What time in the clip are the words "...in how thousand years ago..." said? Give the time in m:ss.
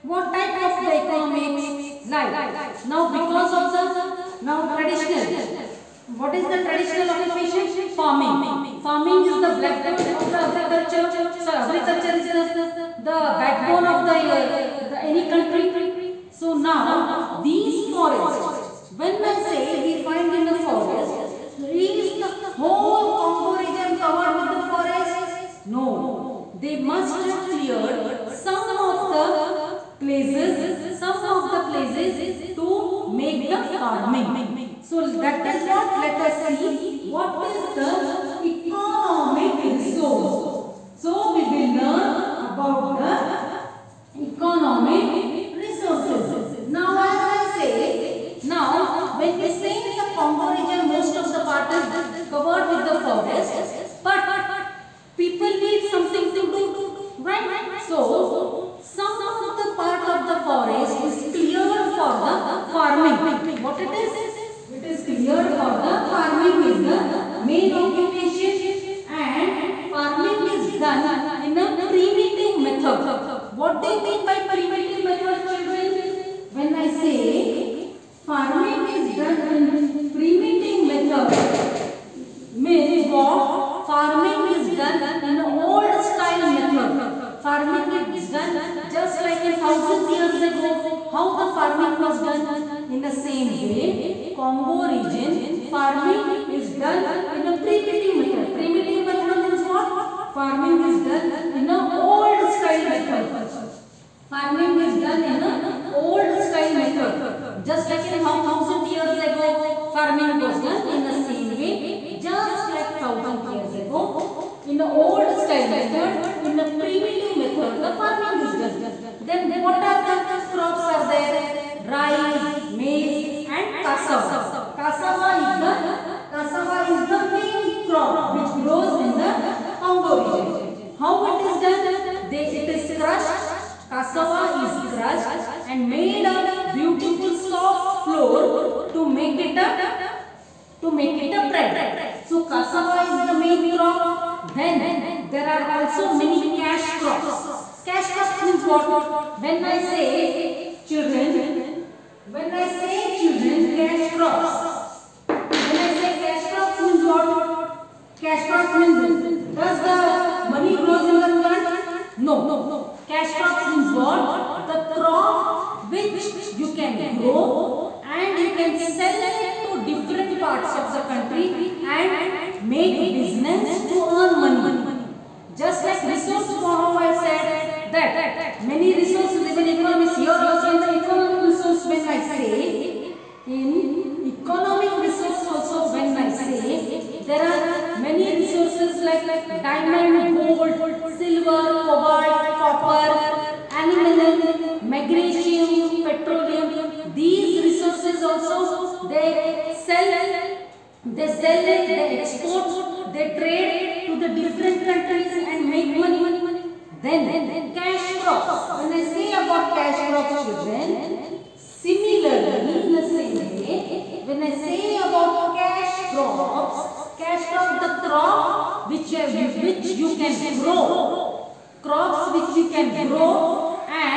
1:48.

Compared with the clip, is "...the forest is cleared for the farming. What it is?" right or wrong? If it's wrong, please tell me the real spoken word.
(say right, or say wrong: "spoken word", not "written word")
right.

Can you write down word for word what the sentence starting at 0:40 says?
So we will learn about the economic resources.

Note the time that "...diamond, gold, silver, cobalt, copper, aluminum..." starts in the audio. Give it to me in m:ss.
3:09.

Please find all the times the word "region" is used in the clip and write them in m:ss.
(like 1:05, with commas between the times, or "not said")
0:23, 0:50, 1:34, 2:10.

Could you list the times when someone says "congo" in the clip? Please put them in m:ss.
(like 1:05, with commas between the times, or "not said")
0:23, 0:50, 1:34, 2:09.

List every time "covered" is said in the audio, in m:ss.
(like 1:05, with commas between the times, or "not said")
0:24, 0:52.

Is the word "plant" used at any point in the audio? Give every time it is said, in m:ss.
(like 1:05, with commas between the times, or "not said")
2:41.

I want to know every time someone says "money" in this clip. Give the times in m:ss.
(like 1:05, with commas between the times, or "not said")
2:40, 2:54, 3:25.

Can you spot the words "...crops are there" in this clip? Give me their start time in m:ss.
2:00.